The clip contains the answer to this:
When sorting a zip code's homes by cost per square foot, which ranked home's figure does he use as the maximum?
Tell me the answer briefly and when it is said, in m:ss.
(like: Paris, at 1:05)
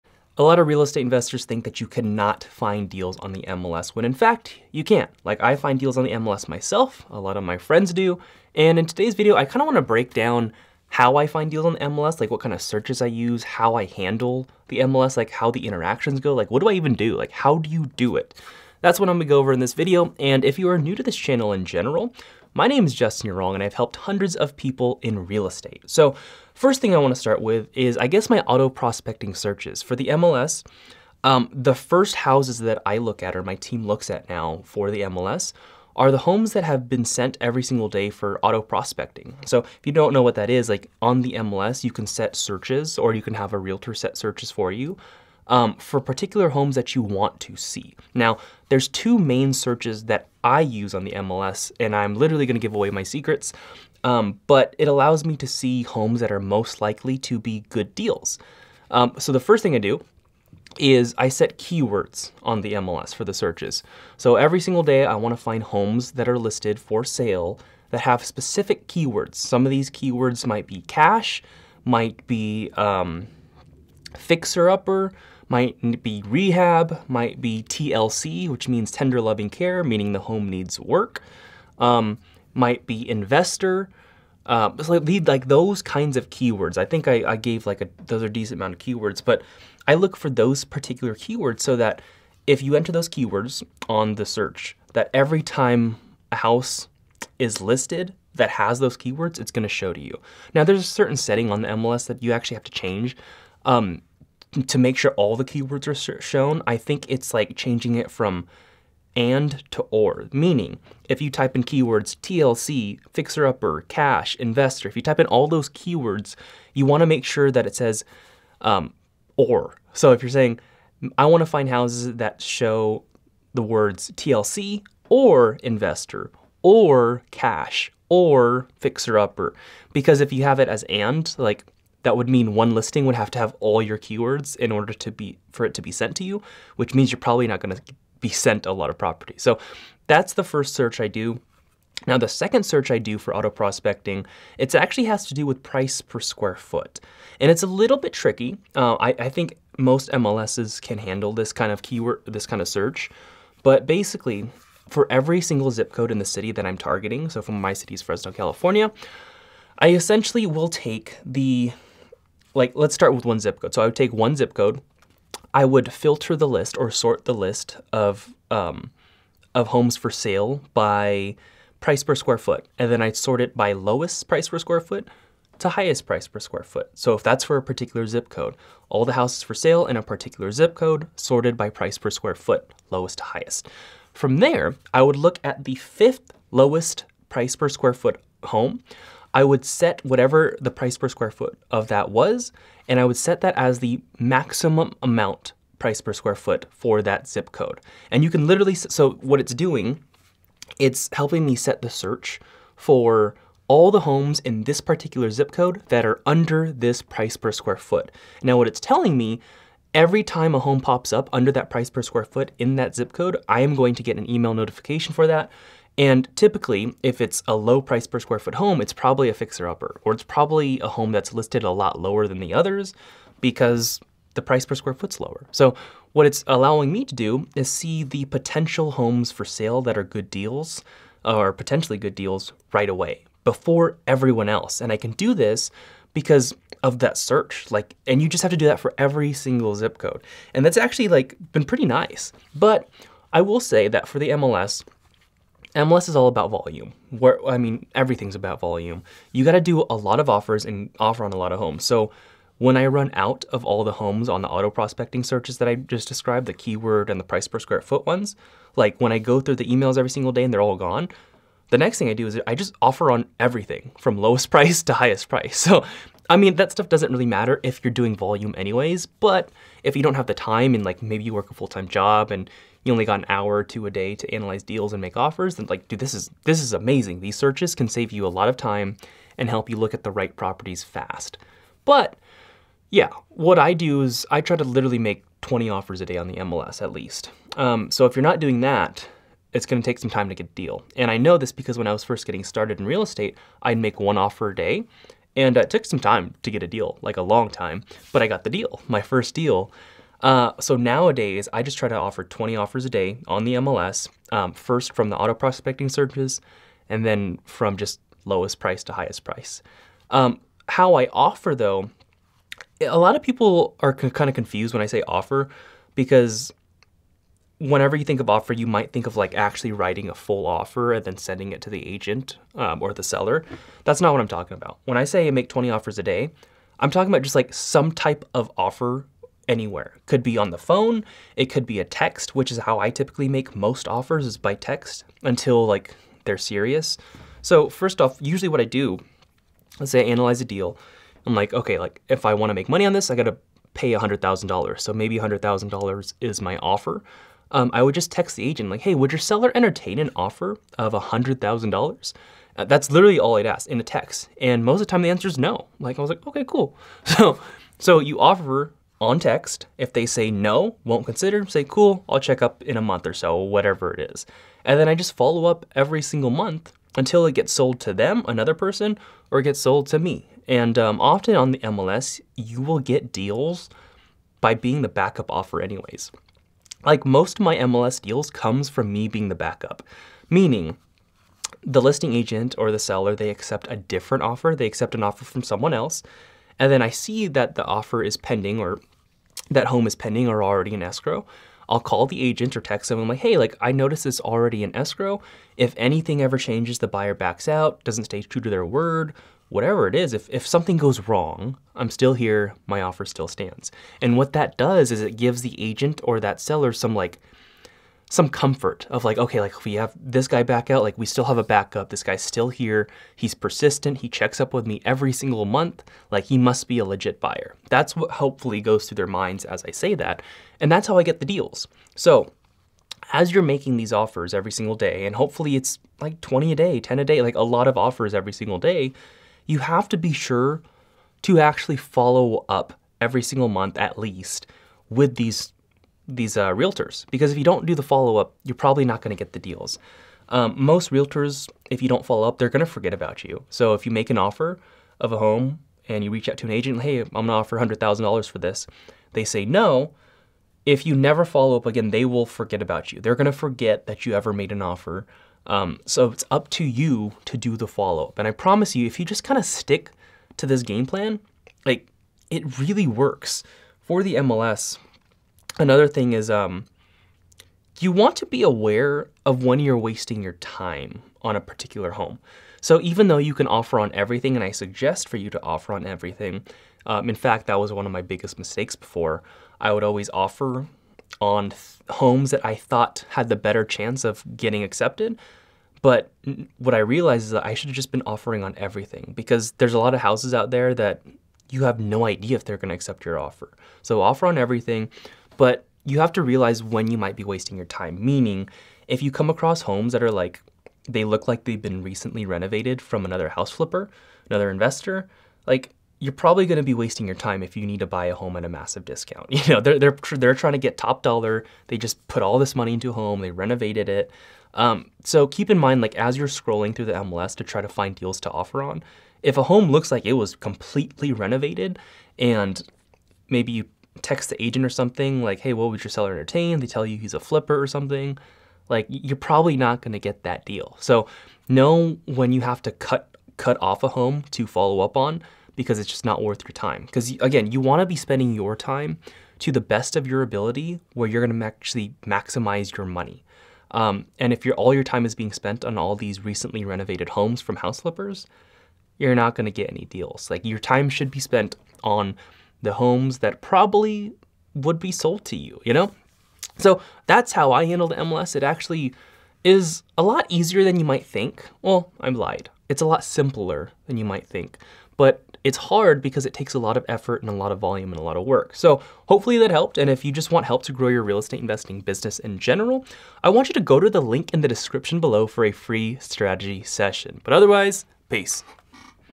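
fifth lowest, at 3:05.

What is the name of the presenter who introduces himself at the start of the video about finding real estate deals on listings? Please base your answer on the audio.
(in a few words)
Justin Yurong.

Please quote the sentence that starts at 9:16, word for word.
So that's how I handled MLS.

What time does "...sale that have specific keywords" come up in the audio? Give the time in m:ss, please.
1:07.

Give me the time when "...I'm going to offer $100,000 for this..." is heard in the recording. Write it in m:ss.
7:26.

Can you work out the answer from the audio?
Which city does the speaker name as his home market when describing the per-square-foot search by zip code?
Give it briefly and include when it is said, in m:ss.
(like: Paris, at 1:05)
Fresno, California, at 2:38.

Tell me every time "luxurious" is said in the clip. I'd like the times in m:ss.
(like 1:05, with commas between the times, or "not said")
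not said.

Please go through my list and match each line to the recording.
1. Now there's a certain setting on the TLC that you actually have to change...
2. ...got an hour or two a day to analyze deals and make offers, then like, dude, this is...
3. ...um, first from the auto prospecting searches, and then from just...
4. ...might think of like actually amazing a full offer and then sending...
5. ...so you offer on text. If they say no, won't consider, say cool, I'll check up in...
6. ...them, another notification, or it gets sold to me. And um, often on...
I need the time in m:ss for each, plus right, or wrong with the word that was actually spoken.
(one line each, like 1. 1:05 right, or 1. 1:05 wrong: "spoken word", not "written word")
1. 1:40 wrong: "MLS", not "TLC"
2. 4:33 right
3. 5:04 right
4. 5:18 wrong: "writing", not "amazing"
5. 5:57 right
6. 6:07 wrong: "person", not "notification".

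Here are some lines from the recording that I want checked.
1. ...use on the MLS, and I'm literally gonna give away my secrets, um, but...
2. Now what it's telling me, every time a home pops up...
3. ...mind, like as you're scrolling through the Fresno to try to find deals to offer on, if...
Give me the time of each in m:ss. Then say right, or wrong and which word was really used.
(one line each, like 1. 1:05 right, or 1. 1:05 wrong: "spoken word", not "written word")
1. 0:50 right
2. 3:28 right
3. 8:35 wrong: "MLS", not "Fresno".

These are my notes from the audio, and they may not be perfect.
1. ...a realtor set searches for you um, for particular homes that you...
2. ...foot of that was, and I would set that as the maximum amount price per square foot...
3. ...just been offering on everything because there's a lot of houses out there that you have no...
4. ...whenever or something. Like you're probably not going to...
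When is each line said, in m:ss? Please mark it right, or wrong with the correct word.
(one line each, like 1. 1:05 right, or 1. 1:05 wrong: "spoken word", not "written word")
1. 0:43 right
2. 3:11 right
3. 8:07 right
4. 8:47 wrong: "flipper", not "whenever".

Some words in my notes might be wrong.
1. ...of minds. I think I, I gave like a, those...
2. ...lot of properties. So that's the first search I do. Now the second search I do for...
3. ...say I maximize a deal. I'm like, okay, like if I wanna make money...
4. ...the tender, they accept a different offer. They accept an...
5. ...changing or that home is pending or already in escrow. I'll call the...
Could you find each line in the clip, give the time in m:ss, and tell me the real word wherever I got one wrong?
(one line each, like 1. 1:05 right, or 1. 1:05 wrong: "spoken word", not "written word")
1. 1:26 wrong: "keywords", not "minds"
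2. 2:18 right
3. 5:39 wrong: "analyze", not "maximize"
4. 6:22 wrong: "seller", not "tender"
5. 6:28 wrong: "pending", not "changing".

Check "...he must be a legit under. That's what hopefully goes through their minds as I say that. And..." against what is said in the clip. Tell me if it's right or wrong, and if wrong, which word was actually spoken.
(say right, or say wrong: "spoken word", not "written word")
wrong: "buyer", not "under".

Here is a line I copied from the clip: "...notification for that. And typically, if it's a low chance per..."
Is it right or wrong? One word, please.
wrong.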